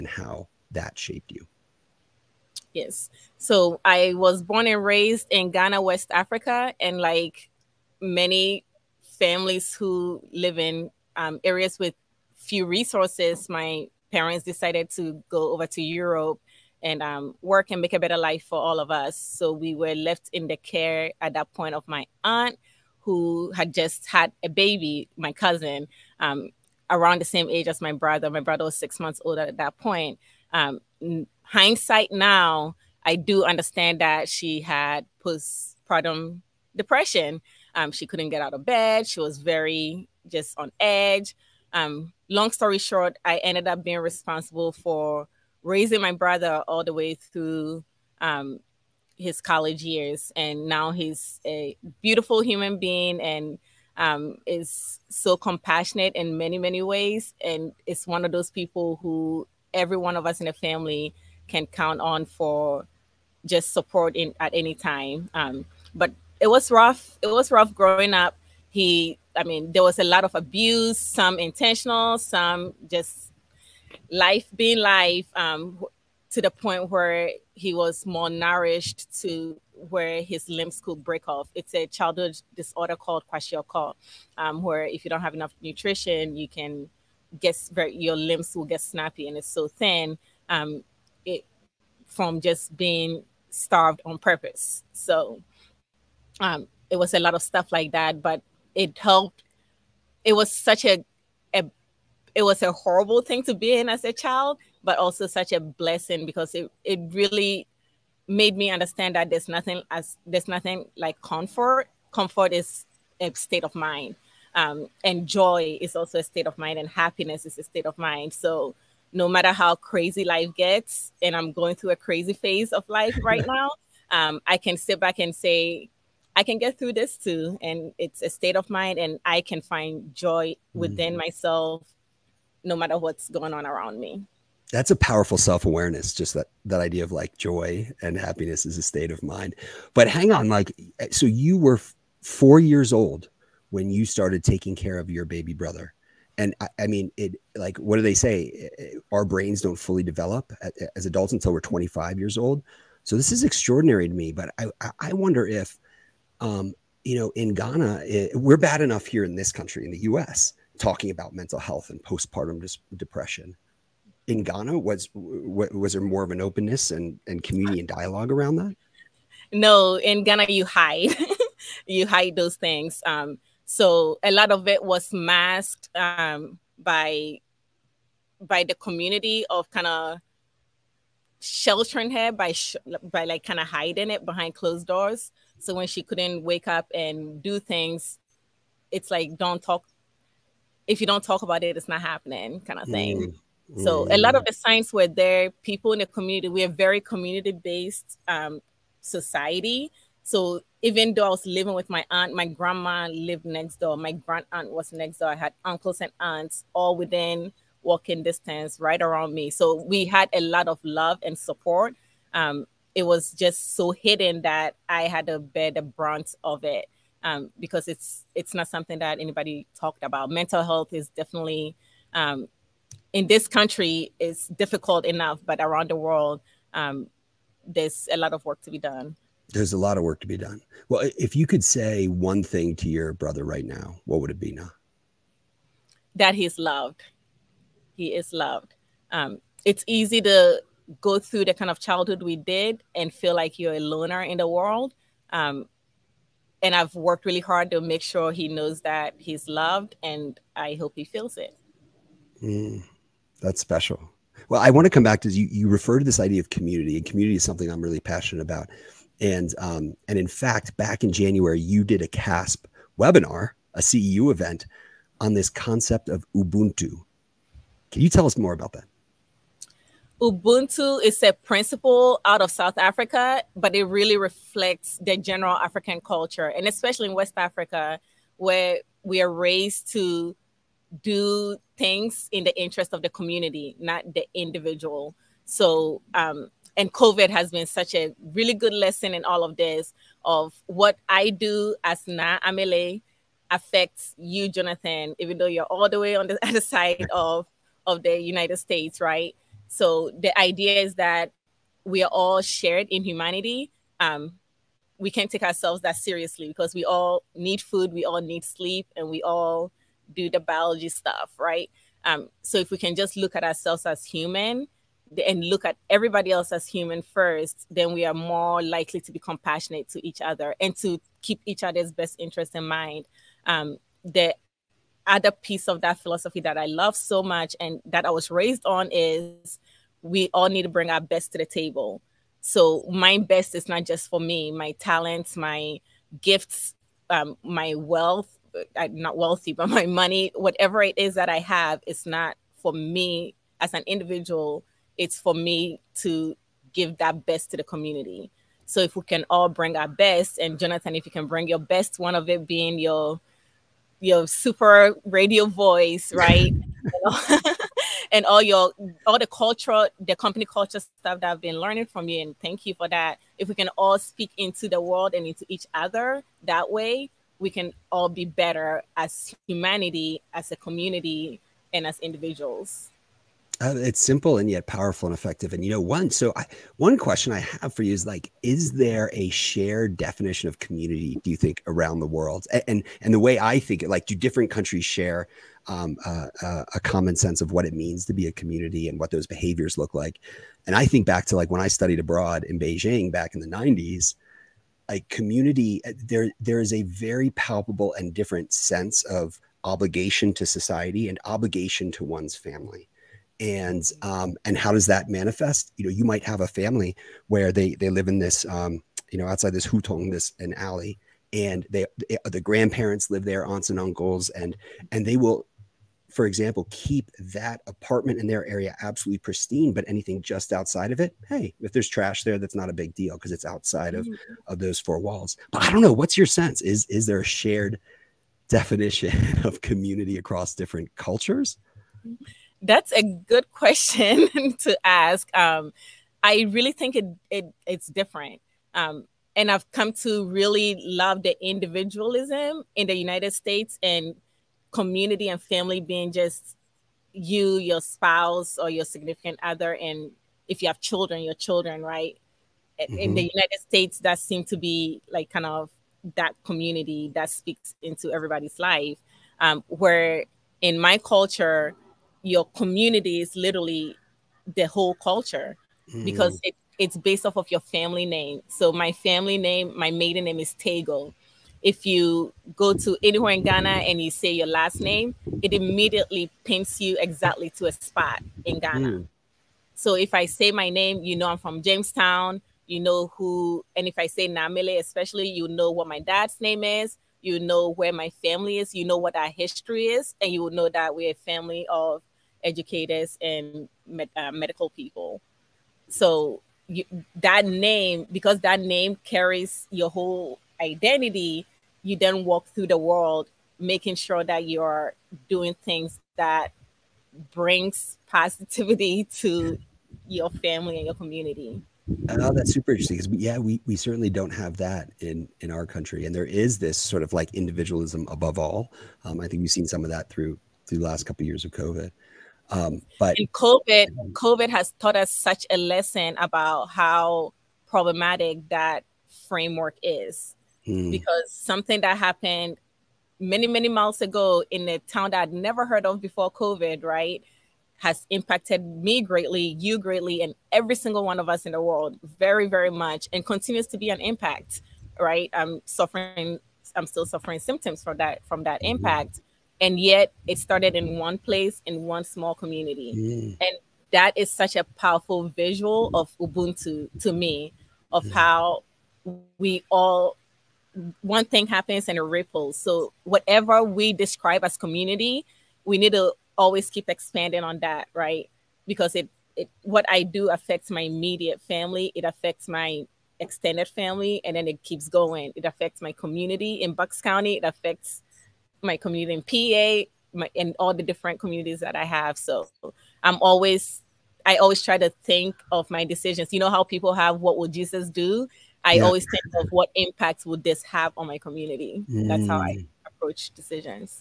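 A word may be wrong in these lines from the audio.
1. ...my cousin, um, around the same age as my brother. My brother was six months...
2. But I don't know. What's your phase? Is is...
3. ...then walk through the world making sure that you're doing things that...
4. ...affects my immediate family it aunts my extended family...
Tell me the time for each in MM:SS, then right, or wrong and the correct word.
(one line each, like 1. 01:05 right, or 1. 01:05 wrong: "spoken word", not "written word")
1. 00:25 right
2. 07:05 wrong: "sense", not "phase"
3. 08:21 right
4. 09:30 wrong: "affects", not "aunts".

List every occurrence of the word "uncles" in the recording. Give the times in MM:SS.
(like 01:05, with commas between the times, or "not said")
03:25, 06:53.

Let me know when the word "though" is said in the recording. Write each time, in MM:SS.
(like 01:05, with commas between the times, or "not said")
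03:21, 04:55.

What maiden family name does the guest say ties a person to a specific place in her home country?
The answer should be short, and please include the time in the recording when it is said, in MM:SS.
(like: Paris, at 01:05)
Tego, at 07:50.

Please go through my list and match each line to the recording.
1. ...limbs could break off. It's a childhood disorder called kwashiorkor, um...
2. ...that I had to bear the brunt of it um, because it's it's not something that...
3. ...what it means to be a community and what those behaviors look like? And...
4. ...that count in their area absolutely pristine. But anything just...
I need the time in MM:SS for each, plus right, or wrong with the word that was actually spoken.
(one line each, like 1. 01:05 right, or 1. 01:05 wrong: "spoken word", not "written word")
1. 01:20 right
2. 03:34 right
3. 06:27 right
4. 06:57 wrong: "apartment", not "count".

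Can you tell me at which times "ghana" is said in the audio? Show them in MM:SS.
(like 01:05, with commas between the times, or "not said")
00:05, 02:37, 02:44, 02:50, 07:53, 07:58.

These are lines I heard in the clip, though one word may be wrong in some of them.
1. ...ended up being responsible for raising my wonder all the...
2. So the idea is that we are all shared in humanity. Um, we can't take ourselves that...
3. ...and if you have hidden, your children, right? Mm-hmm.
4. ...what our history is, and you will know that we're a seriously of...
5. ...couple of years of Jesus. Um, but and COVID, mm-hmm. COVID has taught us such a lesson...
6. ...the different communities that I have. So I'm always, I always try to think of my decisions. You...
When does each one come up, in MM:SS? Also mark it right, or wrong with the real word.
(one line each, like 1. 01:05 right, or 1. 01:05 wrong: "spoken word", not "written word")
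1. 00:43 wrong: "brother", not "wonder"
2. 04:59 right
3. 07:29 wrong: "children", not "hidden"
4. 08:08 wrong: "family", not "seriously"
5. 08:41 wrong: "COVID", not "Jesus"
6. 09:40 right.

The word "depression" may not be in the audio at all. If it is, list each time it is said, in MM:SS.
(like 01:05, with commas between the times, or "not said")
00:36, 02:42.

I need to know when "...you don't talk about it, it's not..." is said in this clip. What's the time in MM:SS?
03:10.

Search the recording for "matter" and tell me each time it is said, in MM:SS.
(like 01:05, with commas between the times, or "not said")
01:59, 02:12.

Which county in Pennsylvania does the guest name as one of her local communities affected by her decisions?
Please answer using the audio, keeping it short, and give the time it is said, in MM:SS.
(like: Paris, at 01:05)
Bucks County, at 09:36.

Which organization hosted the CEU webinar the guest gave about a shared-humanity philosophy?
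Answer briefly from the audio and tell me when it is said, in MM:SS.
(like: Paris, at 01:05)
CASP, at 04:22.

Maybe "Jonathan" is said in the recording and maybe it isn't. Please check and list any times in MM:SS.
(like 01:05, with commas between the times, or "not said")
04:54, 05:50.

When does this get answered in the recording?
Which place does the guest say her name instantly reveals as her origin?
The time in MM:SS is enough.
08:01.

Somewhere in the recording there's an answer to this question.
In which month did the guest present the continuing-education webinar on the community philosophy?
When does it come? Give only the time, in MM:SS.
04:21.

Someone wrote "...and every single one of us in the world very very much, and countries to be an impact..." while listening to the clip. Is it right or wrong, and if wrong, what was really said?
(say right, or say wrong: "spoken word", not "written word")
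wrong: "continues", not "countries".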